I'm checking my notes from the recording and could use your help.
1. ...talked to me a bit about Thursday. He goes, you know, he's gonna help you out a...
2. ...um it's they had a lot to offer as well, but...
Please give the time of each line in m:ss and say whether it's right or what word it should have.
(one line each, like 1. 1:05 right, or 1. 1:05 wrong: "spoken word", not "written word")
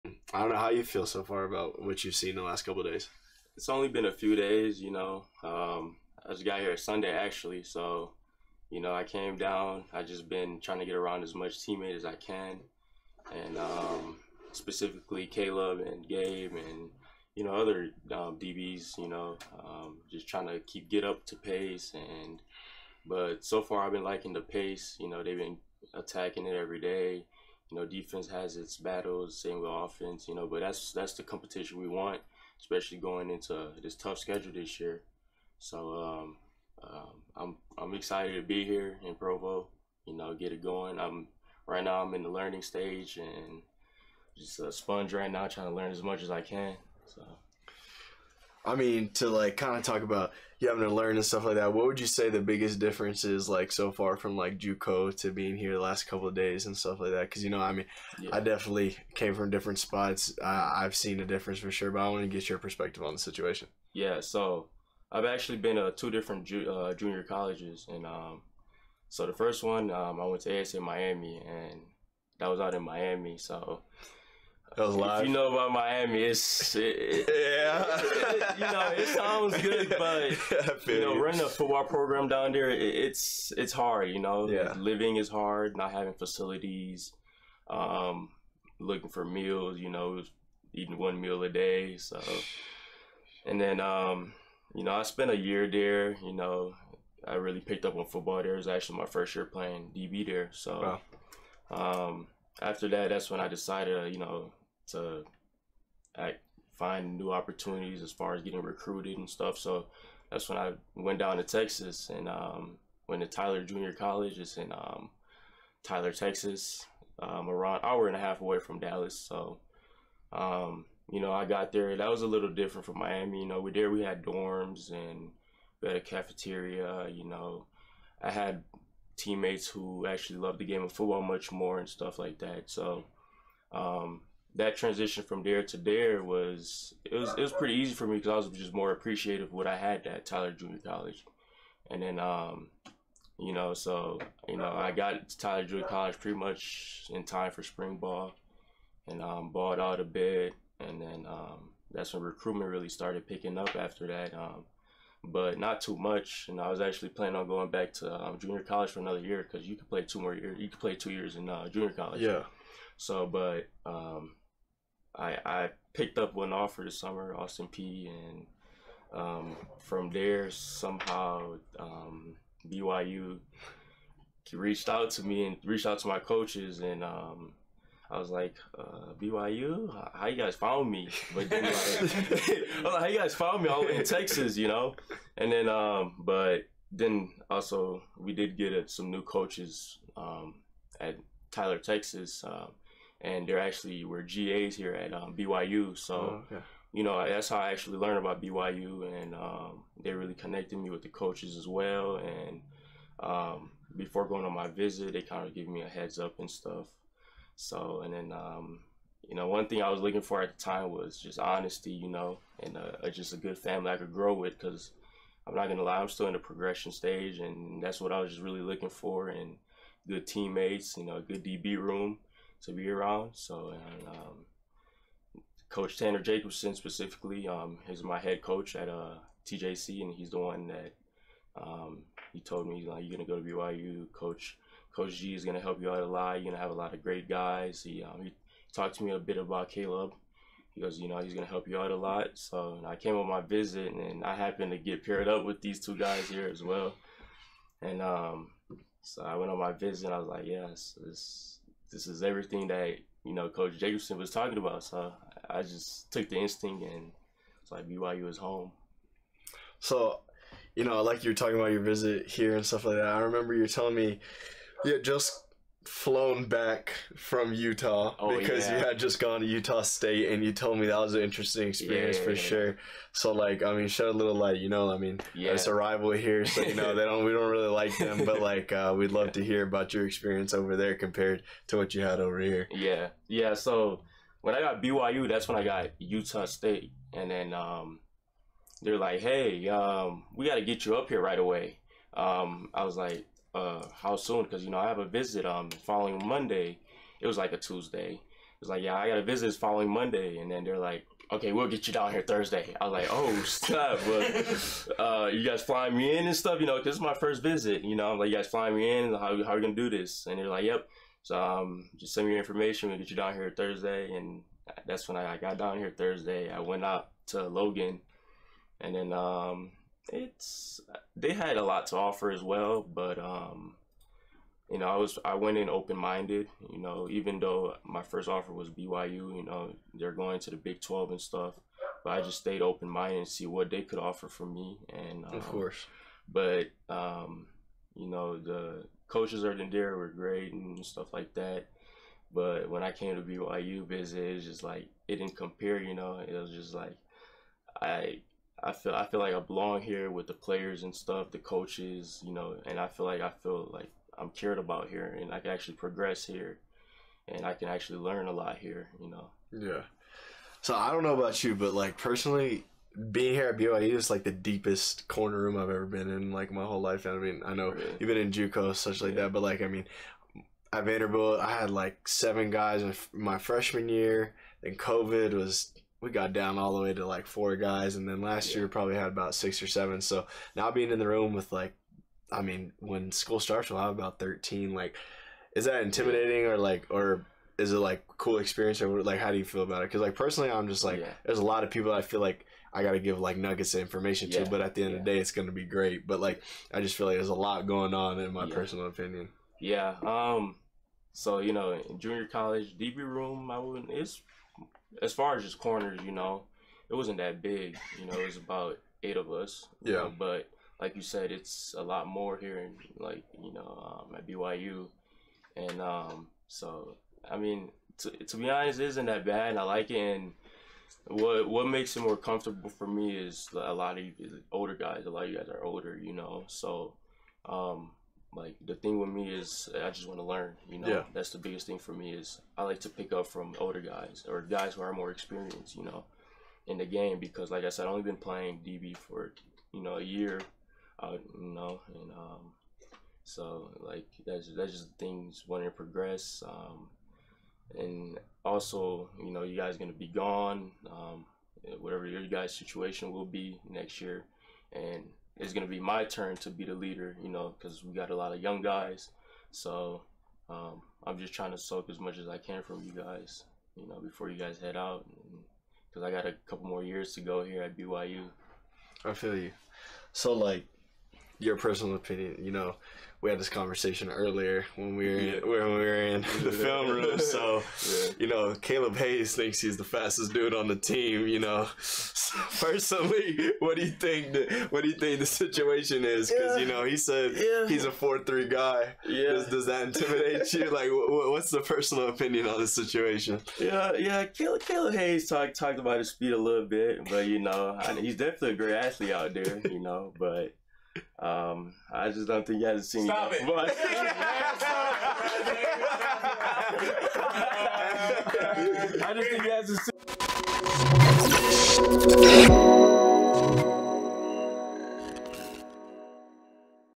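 1. 3:58 wrong: "Kaleb", not "Thursday"
2. 5:19 right.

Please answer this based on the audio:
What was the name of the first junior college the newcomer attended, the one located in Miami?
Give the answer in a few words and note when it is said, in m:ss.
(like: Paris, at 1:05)
ASA Miami, at 1:10.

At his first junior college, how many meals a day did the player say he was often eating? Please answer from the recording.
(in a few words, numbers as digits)
1.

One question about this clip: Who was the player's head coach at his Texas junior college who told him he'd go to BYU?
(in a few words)
Tanner Jacobson.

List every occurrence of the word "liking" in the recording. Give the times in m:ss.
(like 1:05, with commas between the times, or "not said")
0:24.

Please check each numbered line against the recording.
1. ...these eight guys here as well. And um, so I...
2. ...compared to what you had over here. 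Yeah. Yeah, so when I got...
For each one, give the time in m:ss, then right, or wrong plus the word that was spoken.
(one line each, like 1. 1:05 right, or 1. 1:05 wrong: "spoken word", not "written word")
1. 4:05 wrong: "two", not "eight"
2. 4:40 right.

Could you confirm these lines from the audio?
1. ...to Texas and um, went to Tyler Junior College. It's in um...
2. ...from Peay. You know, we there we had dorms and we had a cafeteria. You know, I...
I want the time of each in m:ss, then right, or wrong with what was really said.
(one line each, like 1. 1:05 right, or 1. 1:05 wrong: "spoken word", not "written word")
1. 1:51 right
2. 2:02 wrong: "Miami", not "Peay".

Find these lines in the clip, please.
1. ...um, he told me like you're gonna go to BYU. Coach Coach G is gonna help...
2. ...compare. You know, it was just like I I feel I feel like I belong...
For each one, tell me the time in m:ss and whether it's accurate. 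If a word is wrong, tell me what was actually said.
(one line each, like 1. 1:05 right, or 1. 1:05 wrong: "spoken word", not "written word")
1. 3:51 right
2. 5:45 right.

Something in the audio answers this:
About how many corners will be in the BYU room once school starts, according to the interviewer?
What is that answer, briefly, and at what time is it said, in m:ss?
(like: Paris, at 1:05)
13, at 6:24.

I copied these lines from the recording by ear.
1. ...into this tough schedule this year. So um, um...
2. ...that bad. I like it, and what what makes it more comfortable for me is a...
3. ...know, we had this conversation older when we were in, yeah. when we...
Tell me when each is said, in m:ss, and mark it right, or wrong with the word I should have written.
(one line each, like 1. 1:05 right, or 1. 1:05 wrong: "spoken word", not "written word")
1. 0:33 right
2. 6:59 right
3. 7:52 wrong: "earlier", not "older".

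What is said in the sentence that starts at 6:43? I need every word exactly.
It's as far as just corners, you know, it wasn't that big.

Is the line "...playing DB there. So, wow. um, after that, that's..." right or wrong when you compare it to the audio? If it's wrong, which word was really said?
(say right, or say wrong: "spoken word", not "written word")
right.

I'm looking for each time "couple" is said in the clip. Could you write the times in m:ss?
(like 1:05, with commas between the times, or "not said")
0:02, 0:56, 7:46.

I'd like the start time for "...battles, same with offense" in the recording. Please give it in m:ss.
0:28.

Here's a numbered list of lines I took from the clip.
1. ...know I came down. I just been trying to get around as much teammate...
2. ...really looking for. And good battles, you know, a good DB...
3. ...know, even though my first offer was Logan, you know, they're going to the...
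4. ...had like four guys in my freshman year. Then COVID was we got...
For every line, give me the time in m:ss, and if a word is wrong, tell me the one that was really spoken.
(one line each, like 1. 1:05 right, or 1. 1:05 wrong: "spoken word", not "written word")
1. 0:08 right
2. 3:38 wrong: "teammates", not "battles"
3. 5:26 wrong: "BYU", not "Logan"
4. 6:11 wrong: "seven", not "four".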